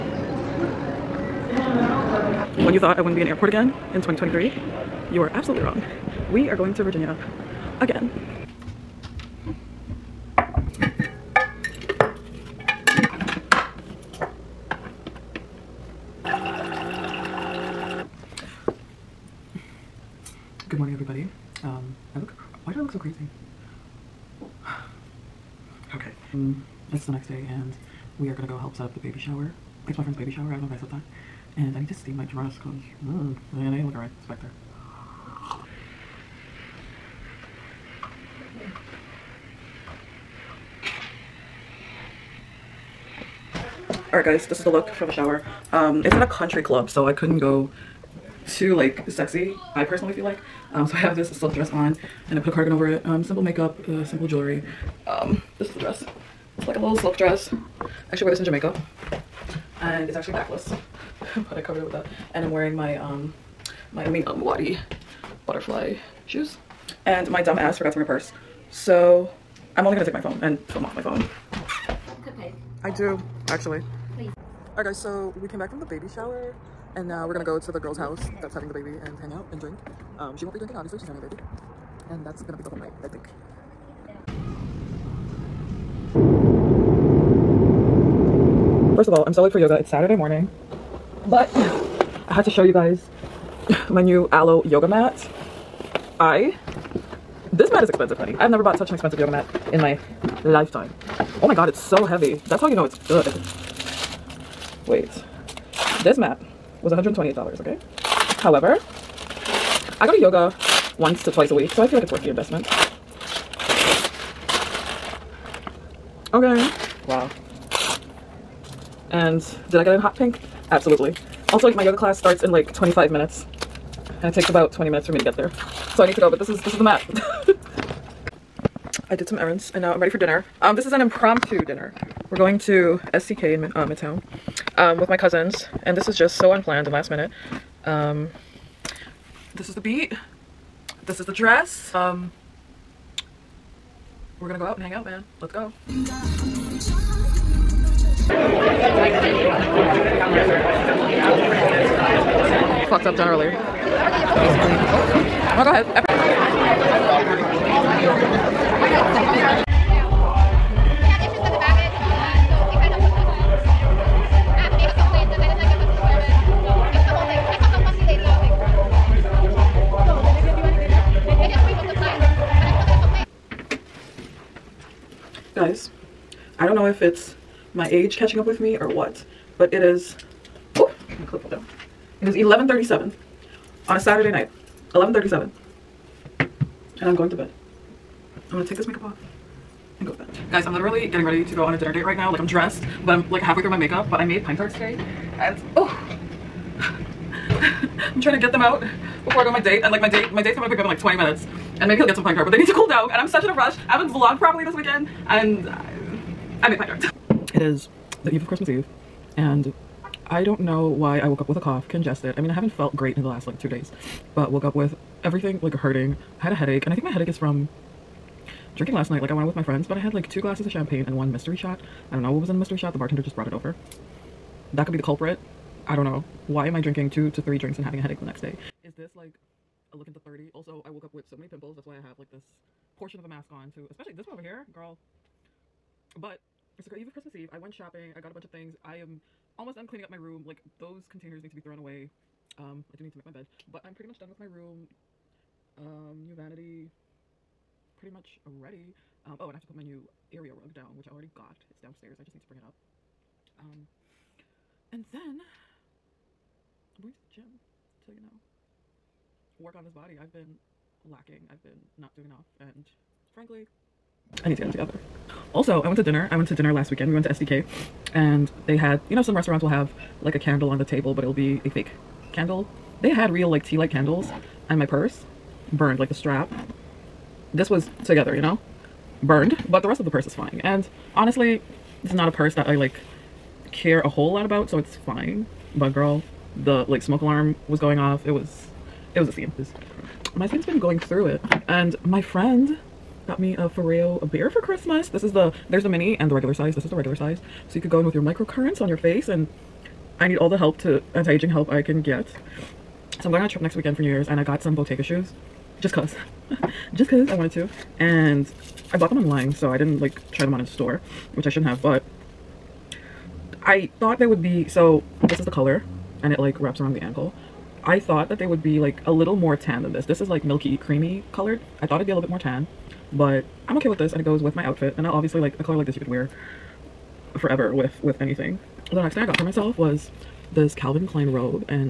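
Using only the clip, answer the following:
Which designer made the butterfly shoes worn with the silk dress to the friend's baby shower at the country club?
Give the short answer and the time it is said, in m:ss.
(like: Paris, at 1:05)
Amina Muaddi, at 1:04.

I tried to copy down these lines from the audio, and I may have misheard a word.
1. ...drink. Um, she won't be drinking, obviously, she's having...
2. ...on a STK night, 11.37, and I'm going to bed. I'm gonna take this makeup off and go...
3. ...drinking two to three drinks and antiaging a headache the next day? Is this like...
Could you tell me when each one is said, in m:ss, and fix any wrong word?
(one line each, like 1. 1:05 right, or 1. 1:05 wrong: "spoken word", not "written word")
1. 1:19 right
2. 3:03 wrong: "Saturday", not "STK"
3. 3:46 wrong: "having", not "antiaging".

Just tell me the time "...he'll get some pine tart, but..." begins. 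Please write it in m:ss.
3:21.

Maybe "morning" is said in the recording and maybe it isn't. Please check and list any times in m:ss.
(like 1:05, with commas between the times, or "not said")
0:20, 1:30.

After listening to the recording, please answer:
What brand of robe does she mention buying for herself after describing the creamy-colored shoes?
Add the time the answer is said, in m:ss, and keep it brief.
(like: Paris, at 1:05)
Calvin Klein, at 5:30.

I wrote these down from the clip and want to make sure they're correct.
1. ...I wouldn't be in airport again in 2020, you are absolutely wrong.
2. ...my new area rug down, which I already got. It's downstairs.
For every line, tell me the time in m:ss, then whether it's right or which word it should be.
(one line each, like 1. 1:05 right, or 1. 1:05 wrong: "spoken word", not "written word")
1. 0:02 wrong: "2023", not "2020"
2. 4:09 right.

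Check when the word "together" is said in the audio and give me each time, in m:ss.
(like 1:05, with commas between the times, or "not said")
4:24, 4:38.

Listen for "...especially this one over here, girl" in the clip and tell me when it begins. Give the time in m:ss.
3:53.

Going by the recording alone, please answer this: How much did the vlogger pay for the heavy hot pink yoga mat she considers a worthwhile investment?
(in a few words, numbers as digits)
$128.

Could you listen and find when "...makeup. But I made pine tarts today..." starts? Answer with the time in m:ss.
3:13.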